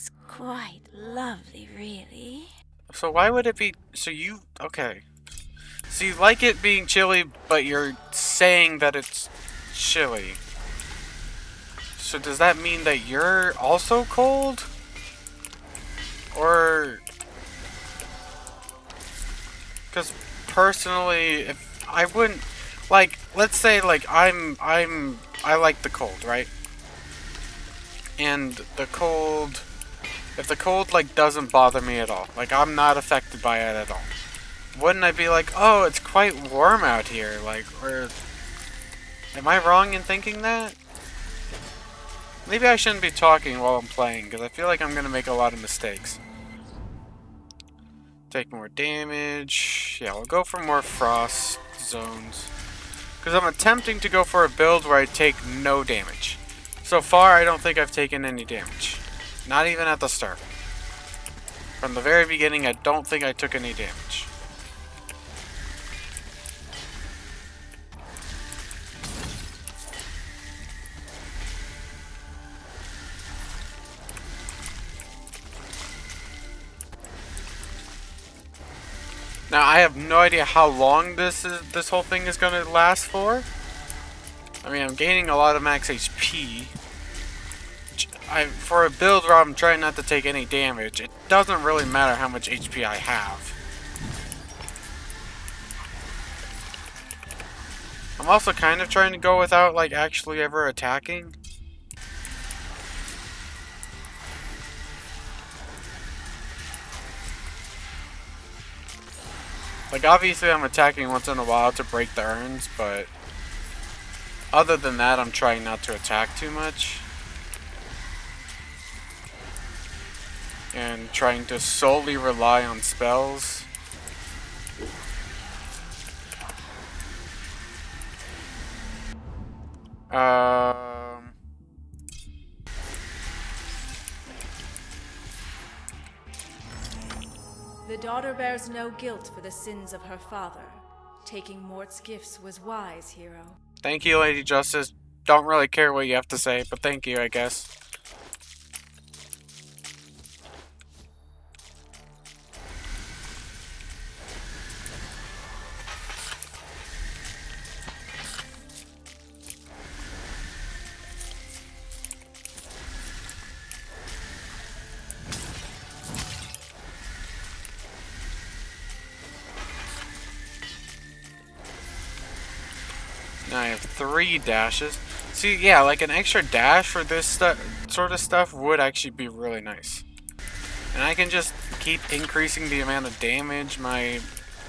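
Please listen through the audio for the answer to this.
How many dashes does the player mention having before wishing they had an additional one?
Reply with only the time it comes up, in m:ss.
2:54.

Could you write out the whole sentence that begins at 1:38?
I'm also kind of trying to go without like actually ever attacking.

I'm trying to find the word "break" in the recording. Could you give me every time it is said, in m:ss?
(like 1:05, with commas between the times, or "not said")
1:51.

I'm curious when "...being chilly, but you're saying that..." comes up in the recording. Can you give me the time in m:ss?
0:06.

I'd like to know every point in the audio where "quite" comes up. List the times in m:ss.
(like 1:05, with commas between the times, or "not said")
0:00, 0:35.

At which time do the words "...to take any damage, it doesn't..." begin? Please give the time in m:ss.
1:29.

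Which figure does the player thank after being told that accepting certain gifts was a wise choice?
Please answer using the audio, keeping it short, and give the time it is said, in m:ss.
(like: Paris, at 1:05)
Lady Justice, at 2:24.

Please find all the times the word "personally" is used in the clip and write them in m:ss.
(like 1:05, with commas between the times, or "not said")
0:20.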